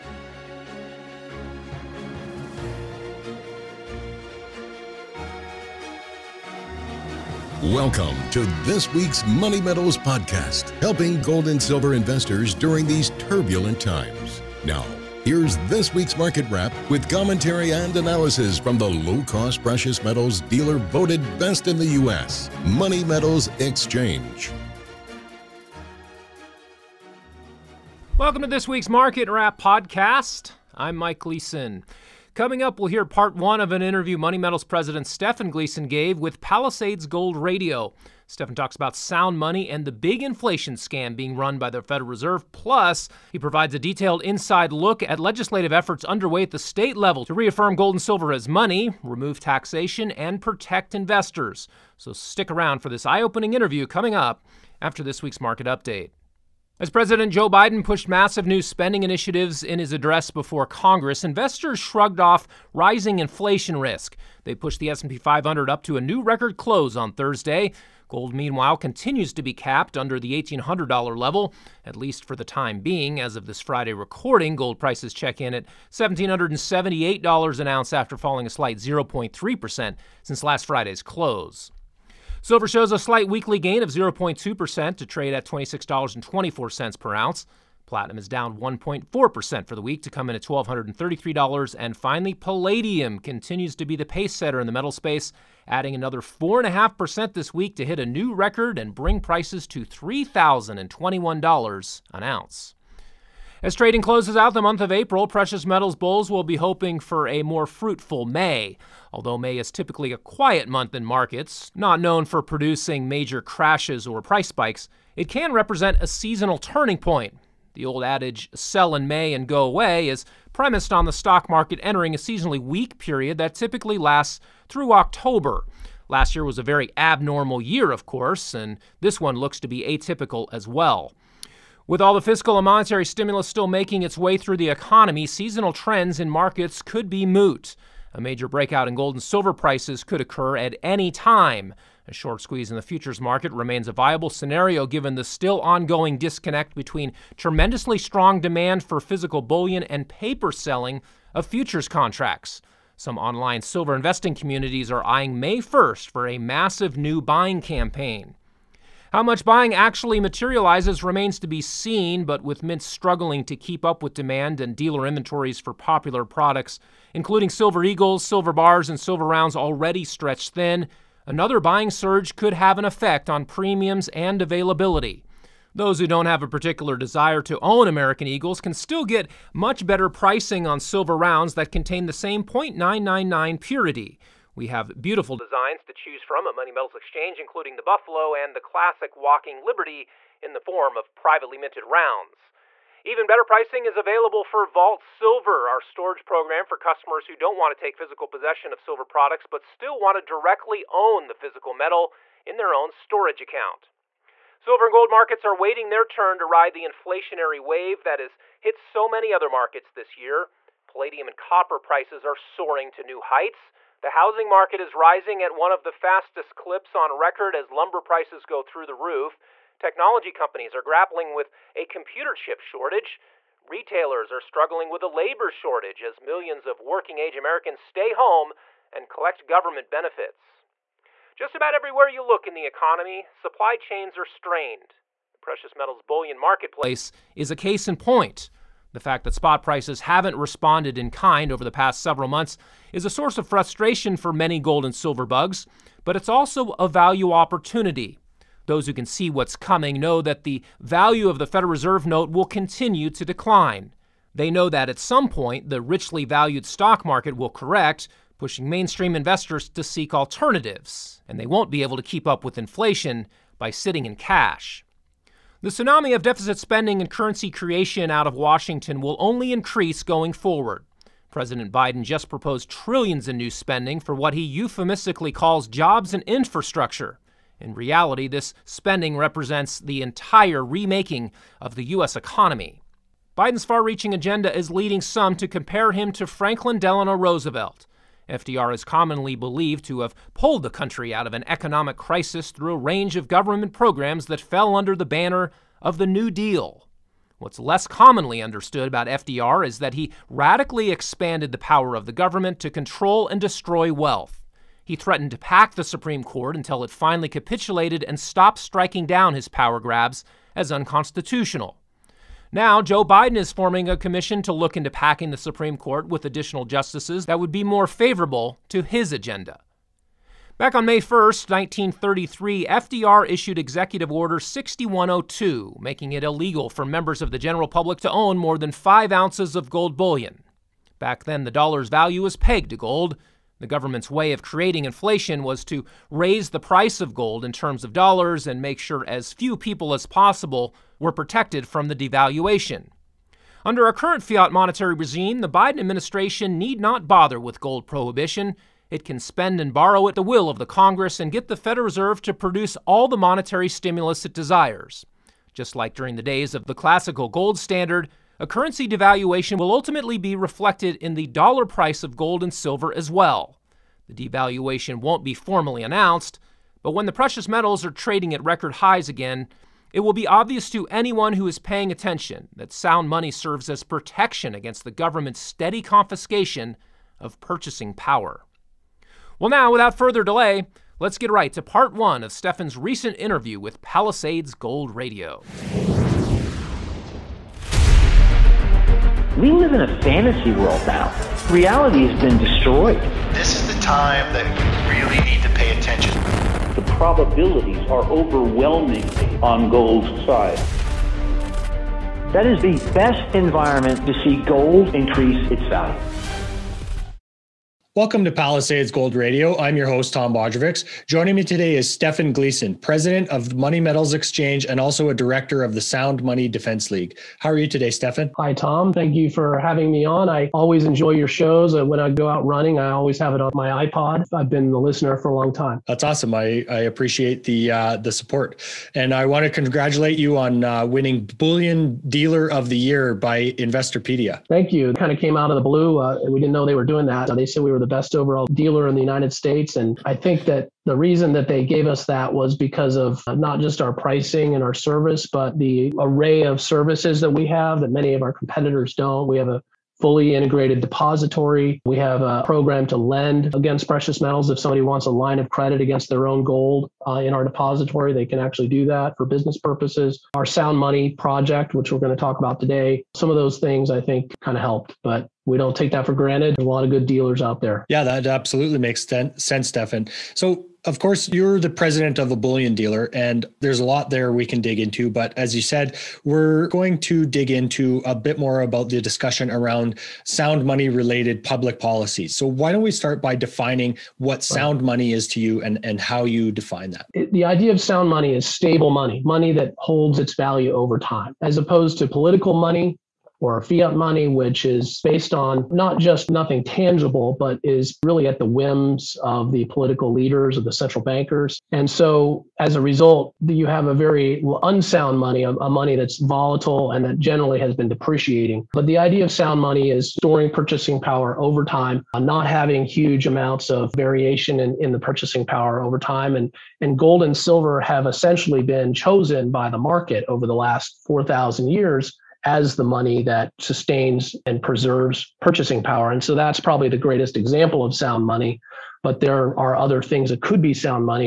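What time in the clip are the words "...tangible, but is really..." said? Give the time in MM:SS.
08:16.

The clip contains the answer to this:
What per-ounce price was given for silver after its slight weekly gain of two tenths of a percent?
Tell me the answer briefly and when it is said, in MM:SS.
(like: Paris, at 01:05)
$26.24, at 01:25.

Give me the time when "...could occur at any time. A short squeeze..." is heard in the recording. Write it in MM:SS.
02:20.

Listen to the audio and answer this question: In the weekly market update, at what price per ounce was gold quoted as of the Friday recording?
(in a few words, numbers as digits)
$1778.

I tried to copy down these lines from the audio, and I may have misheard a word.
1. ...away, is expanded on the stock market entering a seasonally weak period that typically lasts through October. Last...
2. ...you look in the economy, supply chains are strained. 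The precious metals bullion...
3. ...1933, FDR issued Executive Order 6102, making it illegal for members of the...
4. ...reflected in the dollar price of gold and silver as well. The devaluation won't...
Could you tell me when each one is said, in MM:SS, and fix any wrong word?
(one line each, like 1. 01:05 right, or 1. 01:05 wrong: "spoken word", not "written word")
1. 01:59 wrong: "premised", not "expanded"
2. 03:52 right
3. 05:21 right
4. 06:00 right.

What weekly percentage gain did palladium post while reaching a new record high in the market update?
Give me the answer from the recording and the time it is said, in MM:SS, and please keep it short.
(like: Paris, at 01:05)
4.5%, at 01:36.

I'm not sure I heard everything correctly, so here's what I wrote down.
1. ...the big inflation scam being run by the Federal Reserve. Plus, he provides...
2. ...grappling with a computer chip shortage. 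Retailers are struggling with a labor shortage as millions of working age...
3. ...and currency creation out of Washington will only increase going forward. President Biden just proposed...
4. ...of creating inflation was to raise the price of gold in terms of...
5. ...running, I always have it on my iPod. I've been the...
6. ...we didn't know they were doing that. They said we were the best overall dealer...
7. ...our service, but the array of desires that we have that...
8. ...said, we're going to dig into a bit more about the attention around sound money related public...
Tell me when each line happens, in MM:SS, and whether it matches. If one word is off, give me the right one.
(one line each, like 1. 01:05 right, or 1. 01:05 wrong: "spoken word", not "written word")
1. 00:39 right
2. 03:40 right
3. 04:26 right
4. 05:34 right
5. 07:02 right
6. 07:16 right
7. 07:24 wrong: "services", not "desires"
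8. 07:55 wrong: "discussion", not "attention".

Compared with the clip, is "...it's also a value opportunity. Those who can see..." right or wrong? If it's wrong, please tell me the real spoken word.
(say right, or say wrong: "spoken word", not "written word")
right.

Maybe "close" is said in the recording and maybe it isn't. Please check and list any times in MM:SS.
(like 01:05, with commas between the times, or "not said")
01:06, 01:21, 01:44.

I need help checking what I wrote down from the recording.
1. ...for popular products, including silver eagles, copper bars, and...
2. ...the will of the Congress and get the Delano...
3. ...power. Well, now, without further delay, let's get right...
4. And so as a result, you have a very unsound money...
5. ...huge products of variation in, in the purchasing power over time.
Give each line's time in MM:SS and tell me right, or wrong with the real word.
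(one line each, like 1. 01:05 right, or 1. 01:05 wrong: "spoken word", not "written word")
1. 02:45 wrong: "silver", not "copper"
2. 05:50 wrong: "Federal", not "Delano"
3. 06:17 right
4. 08:21 right
5. 08:32 wrong: "amounts", not "products".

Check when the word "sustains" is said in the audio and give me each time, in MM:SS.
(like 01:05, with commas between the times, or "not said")
08:43.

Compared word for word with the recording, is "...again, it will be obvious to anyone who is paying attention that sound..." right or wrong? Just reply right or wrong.
right.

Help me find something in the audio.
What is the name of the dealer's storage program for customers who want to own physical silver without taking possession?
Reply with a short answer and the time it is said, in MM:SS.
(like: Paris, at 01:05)
Vault Silver, at 03:14.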